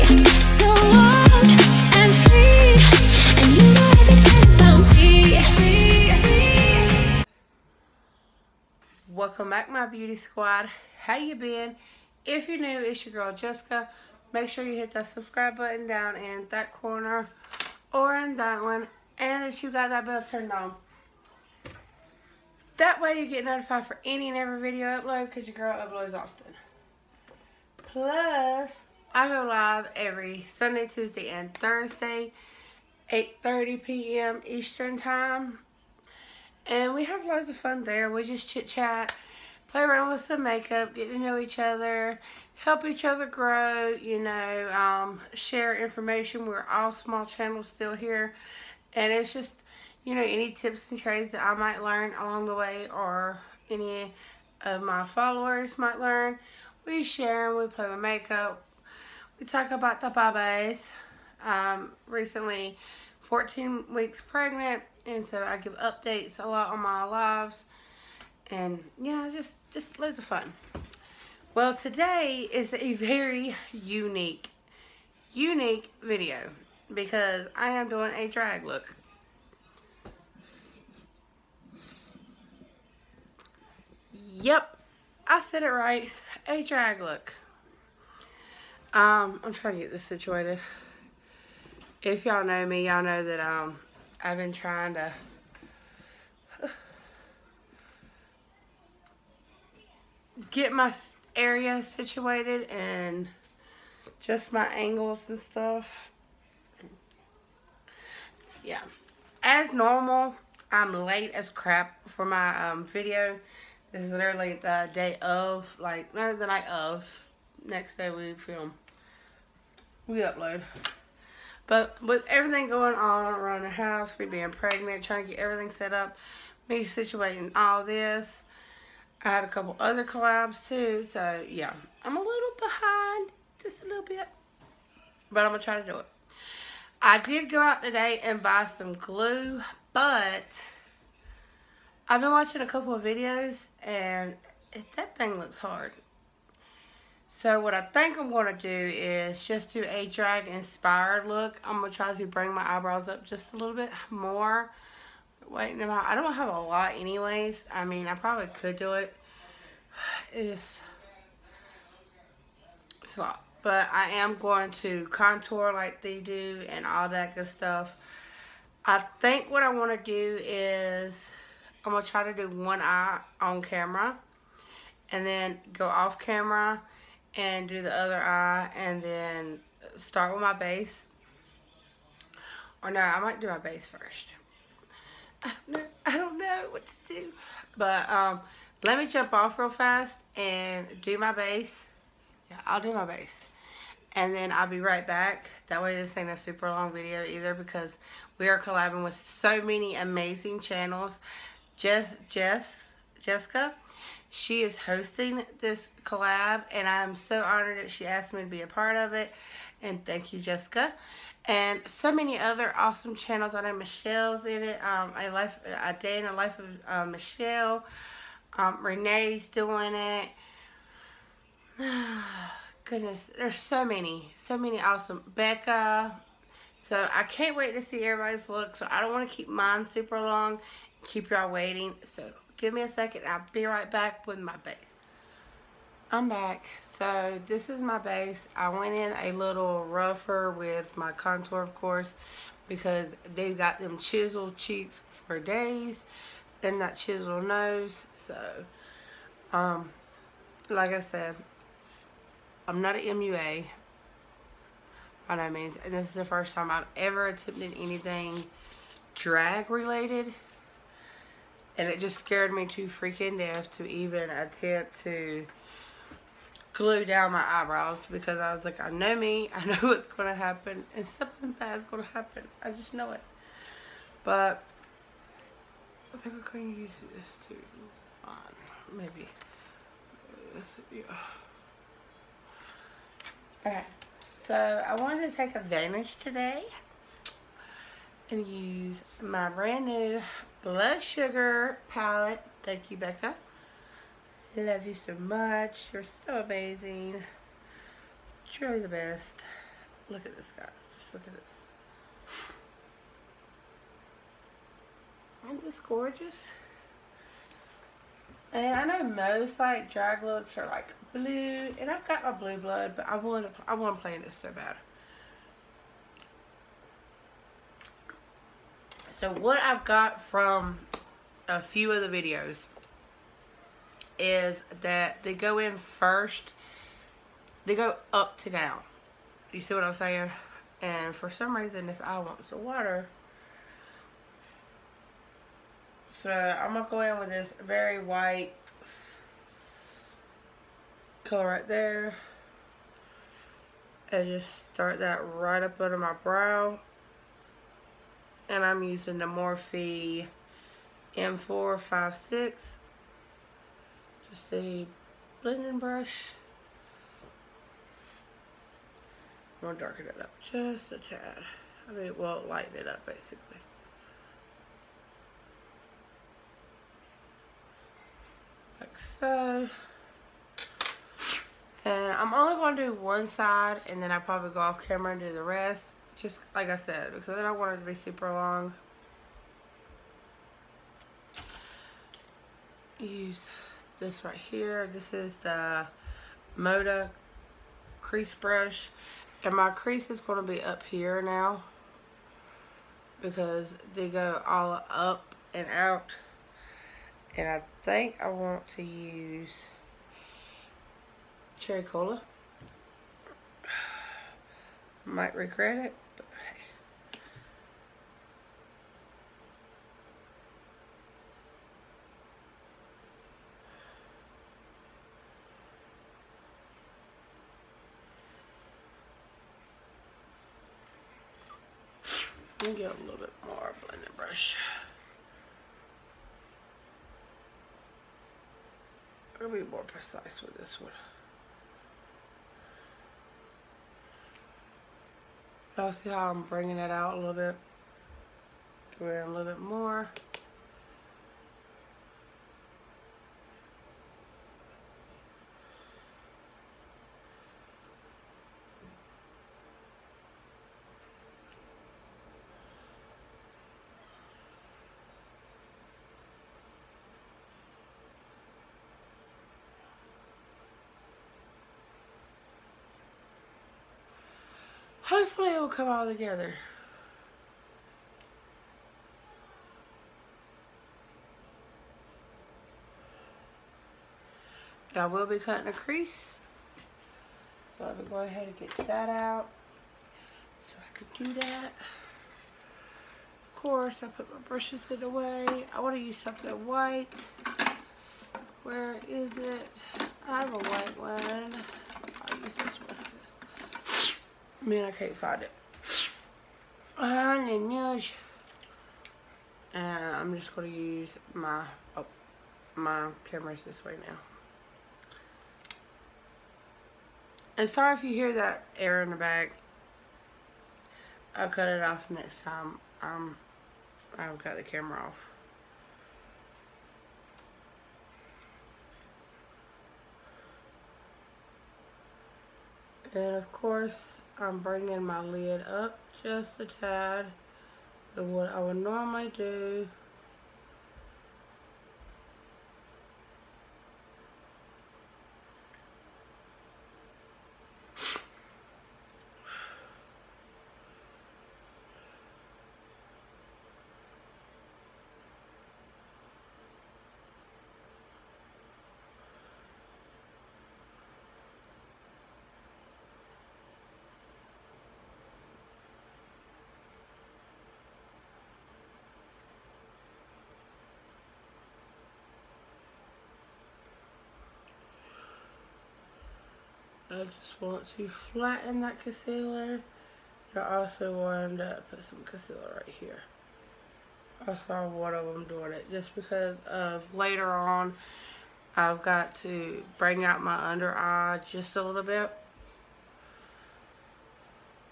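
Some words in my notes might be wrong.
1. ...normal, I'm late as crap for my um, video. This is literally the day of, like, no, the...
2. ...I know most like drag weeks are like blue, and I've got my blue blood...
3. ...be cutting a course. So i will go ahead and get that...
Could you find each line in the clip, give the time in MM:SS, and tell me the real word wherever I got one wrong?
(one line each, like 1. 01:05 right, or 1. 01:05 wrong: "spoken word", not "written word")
1. 01:49 right
2. 05:08 wrong: "looks", not "weeks"
3. 07:55 wrong: "crease", not "course".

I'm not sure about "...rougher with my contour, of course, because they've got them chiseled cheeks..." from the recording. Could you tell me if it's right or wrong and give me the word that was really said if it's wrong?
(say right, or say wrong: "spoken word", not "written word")
right.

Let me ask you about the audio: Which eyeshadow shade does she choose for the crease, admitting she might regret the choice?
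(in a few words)
Cherry Cola.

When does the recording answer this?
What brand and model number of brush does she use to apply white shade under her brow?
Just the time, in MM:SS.
05:49.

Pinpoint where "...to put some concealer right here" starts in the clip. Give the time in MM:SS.
09:31.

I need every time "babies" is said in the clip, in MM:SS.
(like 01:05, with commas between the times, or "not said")
01:00.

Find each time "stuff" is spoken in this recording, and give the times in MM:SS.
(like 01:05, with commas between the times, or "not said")
01:45, 02:47.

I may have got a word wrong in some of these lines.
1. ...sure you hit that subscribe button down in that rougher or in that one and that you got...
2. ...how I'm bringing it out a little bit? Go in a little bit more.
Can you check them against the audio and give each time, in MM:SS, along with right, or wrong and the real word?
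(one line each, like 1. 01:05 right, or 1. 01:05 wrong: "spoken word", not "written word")
1. 00:14 wrong: "corner", not "rougher"
2. 07:16 right.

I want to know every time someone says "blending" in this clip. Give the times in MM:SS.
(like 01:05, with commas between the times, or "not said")
05:55, 07:03.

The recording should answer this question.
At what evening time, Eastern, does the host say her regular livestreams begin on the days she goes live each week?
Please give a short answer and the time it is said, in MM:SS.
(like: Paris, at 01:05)
8:30 p.m., at 00:33.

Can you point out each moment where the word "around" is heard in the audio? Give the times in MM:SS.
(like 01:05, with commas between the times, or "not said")
00:39, 02:03.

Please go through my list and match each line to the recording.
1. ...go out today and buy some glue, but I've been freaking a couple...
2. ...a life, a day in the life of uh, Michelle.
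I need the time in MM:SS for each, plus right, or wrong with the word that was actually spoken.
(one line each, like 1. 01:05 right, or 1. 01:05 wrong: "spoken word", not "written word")
1. 02:17 wrong: "watching", not "freaking"
2. 03:35 right.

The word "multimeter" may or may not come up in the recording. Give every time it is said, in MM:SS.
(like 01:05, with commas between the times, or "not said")
not said.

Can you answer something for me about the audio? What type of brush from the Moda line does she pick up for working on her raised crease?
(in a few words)
Moda crease brush.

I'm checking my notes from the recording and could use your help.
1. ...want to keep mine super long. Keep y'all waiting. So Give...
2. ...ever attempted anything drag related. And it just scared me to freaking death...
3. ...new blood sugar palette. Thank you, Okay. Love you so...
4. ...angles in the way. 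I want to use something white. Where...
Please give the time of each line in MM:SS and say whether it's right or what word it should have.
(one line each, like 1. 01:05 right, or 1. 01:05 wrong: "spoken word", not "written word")
1. 03:49 right
2. 04:16 right
3. 04:49 wrong: "Becca", not "Okay"
4. 08:04 wrong: "brushes", not "angles".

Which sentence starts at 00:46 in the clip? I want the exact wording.
We're all small channels still here.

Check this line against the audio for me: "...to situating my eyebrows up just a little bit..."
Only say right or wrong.
wrong.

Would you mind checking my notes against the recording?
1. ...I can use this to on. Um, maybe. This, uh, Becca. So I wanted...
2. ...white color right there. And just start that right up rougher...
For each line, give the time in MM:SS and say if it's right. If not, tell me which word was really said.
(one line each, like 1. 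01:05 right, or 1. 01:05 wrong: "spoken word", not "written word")
1. 04:36 wrong: "Okay", not "Becca"
2. 05:38 wrong: "under", not "rougher".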